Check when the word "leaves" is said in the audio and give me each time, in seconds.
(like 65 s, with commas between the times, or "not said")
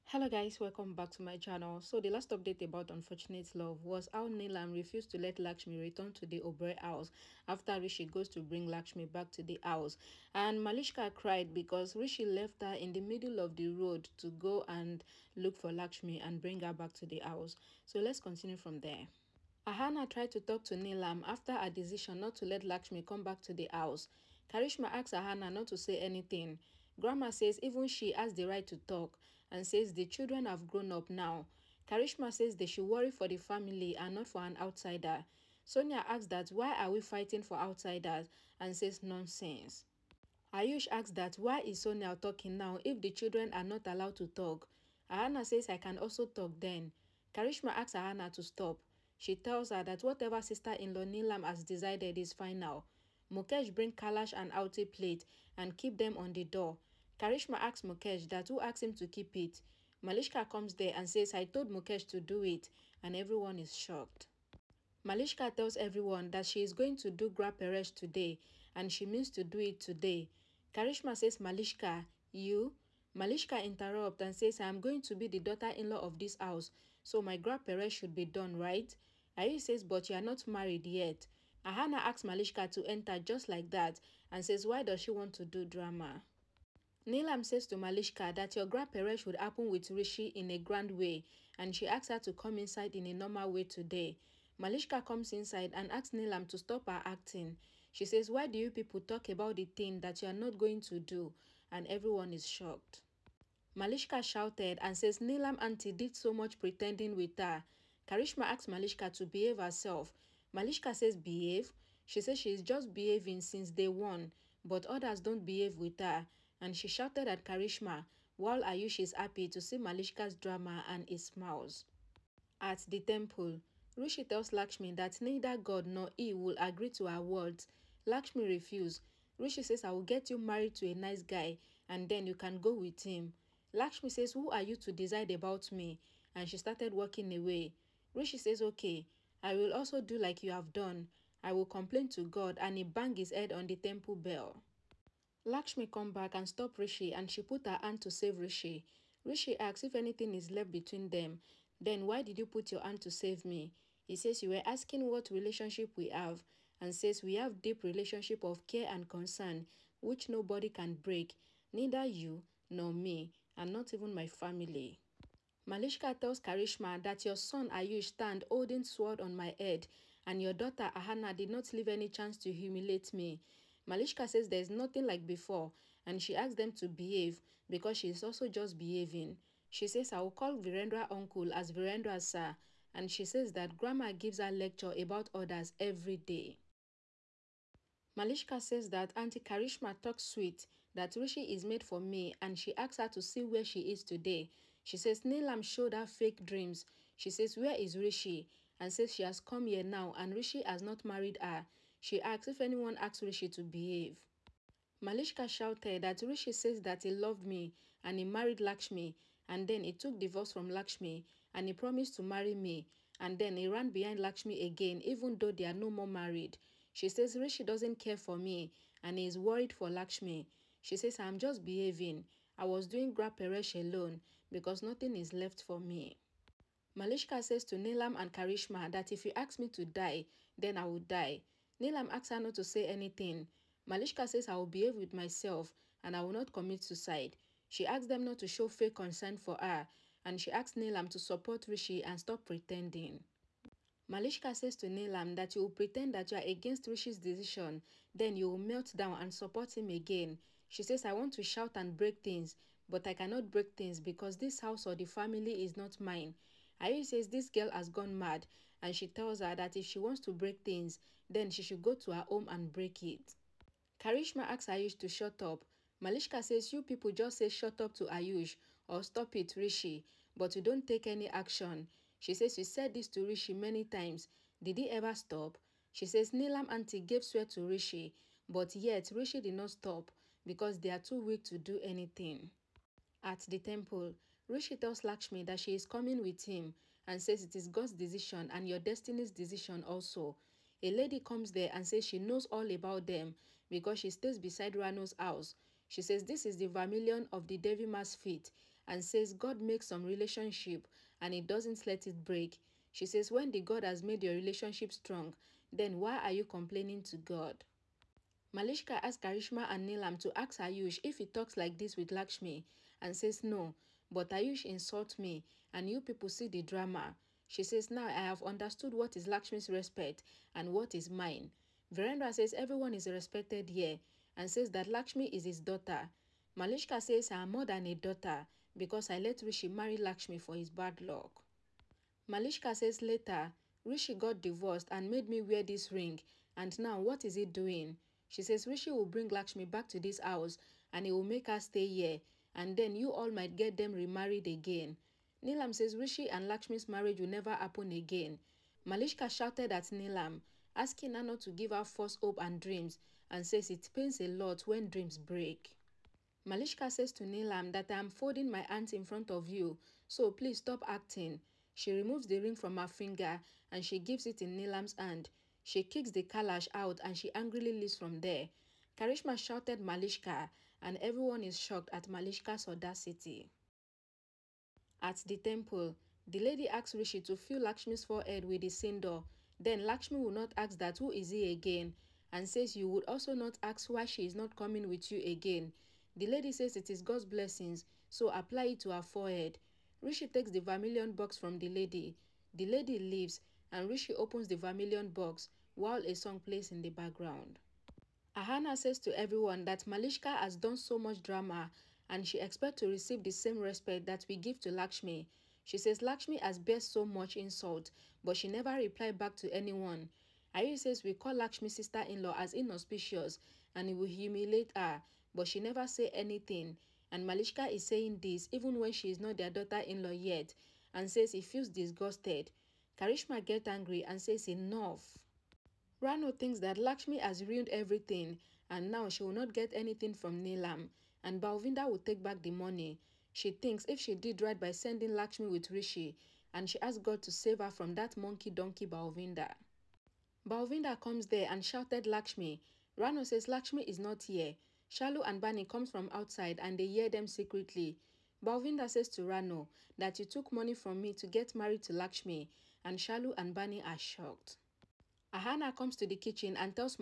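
171 s, 367 s, 392 s.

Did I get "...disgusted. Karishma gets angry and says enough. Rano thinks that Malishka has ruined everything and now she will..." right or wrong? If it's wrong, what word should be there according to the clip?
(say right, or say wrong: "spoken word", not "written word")
wrong: "Lakshmi", not "Malishka".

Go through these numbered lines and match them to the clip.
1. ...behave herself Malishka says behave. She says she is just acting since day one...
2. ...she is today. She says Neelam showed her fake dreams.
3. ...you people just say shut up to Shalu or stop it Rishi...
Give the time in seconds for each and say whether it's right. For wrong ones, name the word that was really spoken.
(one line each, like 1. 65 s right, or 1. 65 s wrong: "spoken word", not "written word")
1. 109 s wrong: "behaving", not "acting"
2. 193 s right
3. 266 s wrong: "Ayush", not "Shalu".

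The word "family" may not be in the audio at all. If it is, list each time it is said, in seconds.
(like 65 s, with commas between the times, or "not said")
33 s, 164 s, 255 s.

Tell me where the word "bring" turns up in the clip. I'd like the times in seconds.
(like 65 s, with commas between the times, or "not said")
8 s, 16 s, 53 s, 339 s.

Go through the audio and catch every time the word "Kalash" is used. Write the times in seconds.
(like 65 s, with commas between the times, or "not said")
53 s, 366 s.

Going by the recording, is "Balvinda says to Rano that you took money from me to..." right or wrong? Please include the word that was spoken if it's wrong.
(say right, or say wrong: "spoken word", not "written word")
right.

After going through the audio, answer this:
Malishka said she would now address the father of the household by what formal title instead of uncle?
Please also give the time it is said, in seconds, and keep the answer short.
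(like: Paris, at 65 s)
Virendra sir, at 181 s.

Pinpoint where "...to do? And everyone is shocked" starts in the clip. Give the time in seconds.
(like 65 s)
100 s.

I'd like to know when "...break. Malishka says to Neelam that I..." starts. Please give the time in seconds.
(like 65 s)
355 s.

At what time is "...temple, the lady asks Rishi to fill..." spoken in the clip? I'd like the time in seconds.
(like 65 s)
375 s.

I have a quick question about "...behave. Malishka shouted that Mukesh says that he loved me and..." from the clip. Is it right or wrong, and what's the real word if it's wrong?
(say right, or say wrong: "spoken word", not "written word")
wrong: "Rishi", not "Mukesh".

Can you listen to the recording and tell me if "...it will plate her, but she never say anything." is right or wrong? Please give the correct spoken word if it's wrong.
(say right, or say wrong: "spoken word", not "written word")
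wrong: "humiliate", not "plate".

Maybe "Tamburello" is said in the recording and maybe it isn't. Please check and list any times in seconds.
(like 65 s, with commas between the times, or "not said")
not said.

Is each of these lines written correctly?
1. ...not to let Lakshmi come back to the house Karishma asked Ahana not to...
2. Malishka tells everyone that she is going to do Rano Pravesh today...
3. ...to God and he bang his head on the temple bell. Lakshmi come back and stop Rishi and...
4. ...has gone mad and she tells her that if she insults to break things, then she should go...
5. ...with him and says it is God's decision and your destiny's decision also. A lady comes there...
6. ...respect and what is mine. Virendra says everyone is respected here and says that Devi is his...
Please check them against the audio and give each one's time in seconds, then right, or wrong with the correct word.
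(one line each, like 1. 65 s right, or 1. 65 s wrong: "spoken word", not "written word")
1. 22 s right
2. 65 s wrong: "Griha", not "Rano"
3. 142 s right
4. 257 s wrong: "wants", not "insults"
5. 286 s right
6. 319 s wrong: "Lakshmi", not "Devi".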